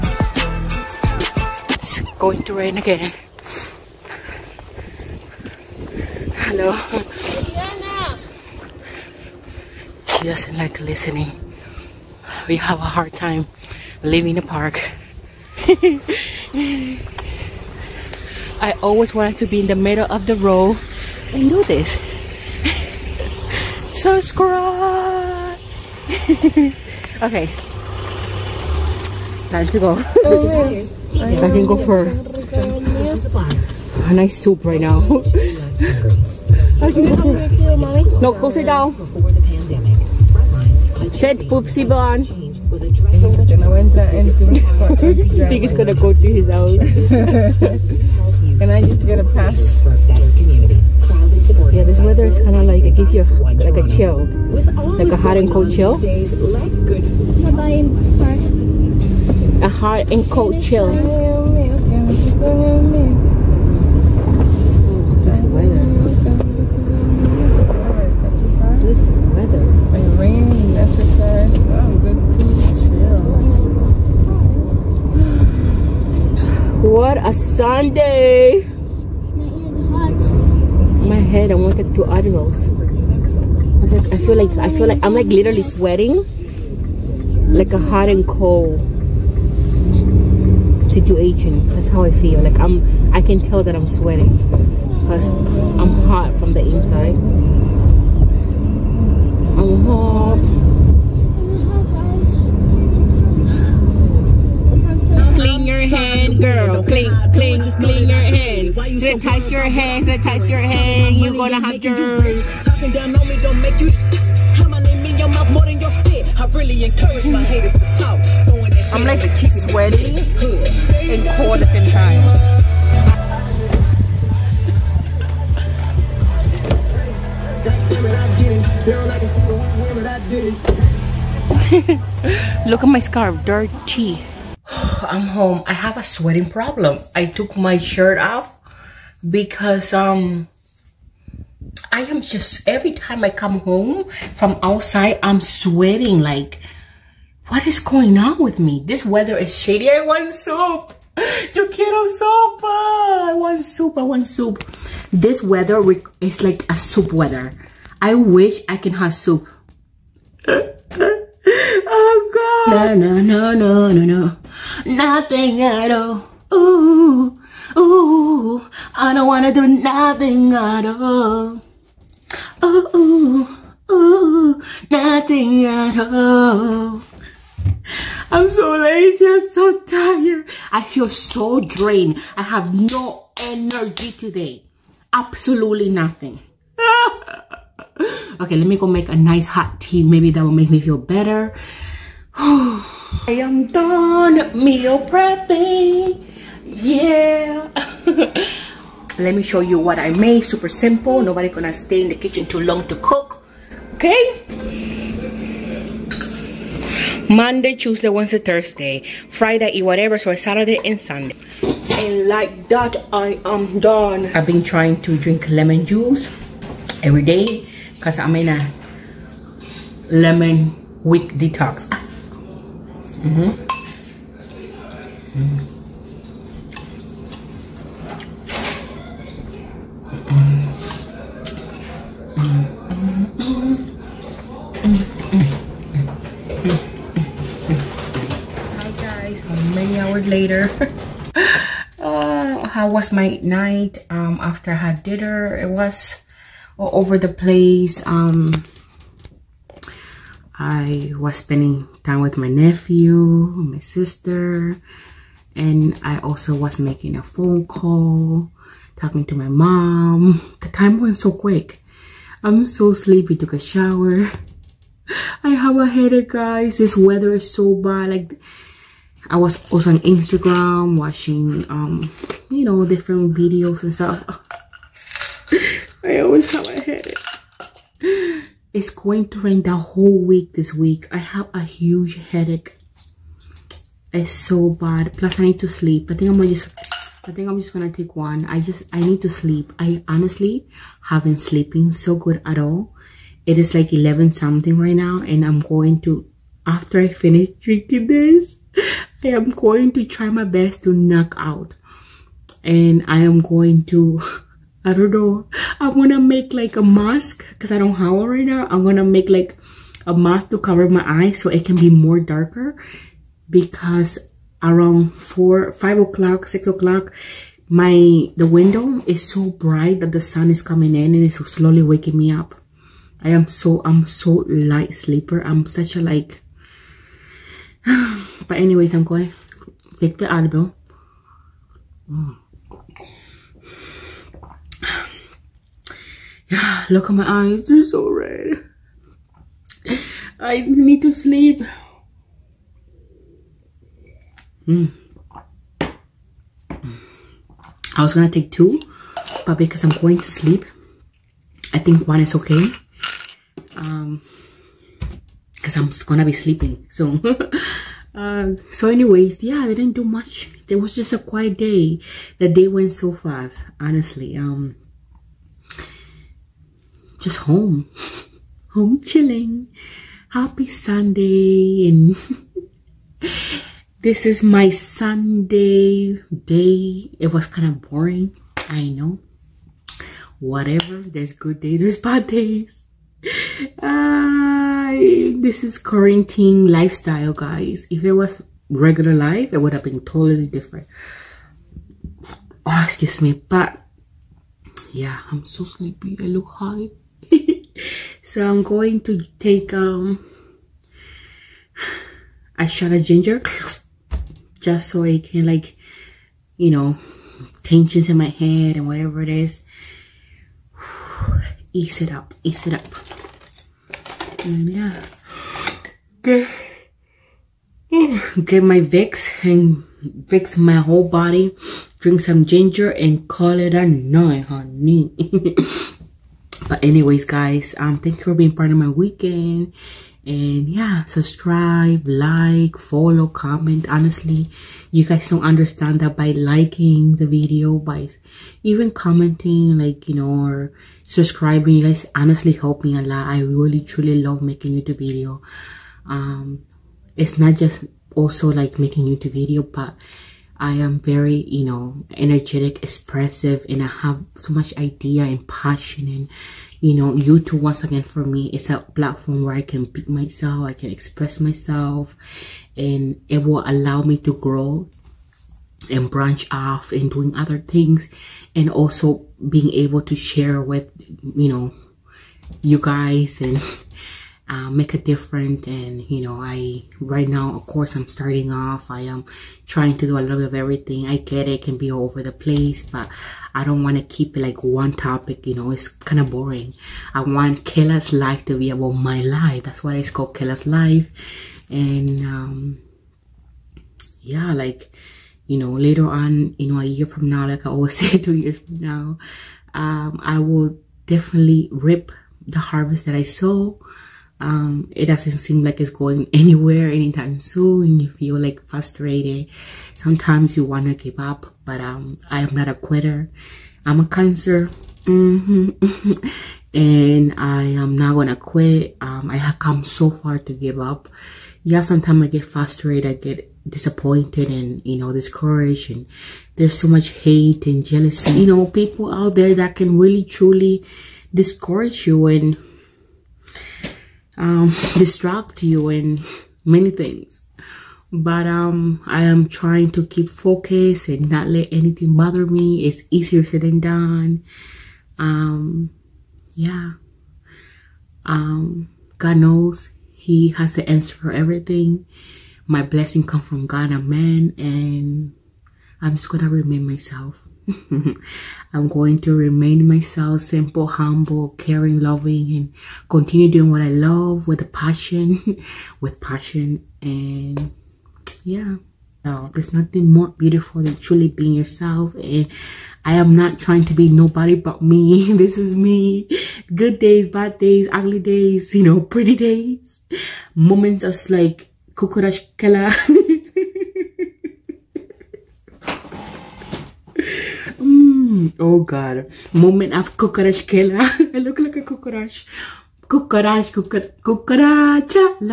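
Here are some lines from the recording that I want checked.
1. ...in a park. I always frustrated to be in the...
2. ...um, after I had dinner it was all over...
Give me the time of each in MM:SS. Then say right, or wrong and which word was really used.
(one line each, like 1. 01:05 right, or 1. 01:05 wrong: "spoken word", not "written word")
1. 00:14 wrong: "wanted", not "frustrated"
2. 04:04 right.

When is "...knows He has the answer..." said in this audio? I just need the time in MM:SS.
09:09.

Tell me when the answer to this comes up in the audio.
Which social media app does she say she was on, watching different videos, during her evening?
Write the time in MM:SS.
04:29.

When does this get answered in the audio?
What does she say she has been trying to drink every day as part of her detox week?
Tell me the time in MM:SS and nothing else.
03:35.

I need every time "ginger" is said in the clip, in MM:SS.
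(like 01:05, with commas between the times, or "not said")
06:43, 07:02.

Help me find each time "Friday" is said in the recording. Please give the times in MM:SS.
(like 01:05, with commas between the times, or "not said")
03:29.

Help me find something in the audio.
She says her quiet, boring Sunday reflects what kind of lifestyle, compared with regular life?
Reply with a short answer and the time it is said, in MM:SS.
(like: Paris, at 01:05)
quarantine lifestyle, at 06:25.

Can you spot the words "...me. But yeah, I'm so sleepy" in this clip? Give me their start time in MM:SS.
06:33.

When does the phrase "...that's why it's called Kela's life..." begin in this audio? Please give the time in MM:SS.
08:09.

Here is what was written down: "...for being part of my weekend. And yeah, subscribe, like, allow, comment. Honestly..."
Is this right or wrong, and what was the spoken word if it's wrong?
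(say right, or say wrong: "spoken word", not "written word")
wrong: "follow", not "allow".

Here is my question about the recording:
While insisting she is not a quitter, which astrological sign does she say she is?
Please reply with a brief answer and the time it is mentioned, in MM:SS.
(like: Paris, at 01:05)
Cancer, at 08:34.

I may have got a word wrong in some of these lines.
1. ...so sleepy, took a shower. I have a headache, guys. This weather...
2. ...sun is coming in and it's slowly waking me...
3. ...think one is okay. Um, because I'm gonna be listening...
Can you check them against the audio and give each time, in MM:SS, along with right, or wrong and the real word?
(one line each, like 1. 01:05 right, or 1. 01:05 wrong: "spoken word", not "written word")
1. 04:22 right
2. 05:20 right
3. 05:51 wrong: "sleeping", not "listening".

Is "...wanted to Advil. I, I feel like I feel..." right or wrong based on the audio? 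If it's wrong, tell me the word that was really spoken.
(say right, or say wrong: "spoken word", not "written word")
wrong: "Admirals", not "Advil".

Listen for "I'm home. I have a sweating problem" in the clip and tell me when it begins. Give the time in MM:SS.
02:15.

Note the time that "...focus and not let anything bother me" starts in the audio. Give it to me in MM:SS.
09:00.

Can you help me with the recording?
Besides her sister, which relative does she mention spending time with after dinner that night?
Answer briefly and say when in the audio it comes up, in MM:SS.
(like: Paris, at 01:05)
nephew, at 04:12.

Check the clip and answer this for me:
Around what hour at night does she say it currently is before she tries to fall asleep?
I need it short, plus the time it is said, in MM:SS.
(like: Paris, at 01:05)
11, at 04:53.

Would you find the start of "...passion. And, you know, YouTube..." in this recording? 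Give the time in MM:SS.
07:35.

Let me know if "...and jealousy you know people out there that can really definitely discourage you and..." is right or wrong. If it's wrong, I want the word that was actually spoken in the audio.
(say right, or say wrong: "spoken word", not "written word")
wrong: "truly", not "definitely".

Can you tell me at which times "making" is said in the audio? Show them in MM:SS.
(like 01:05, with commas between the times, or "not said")
04:16, 07:24, 07:28.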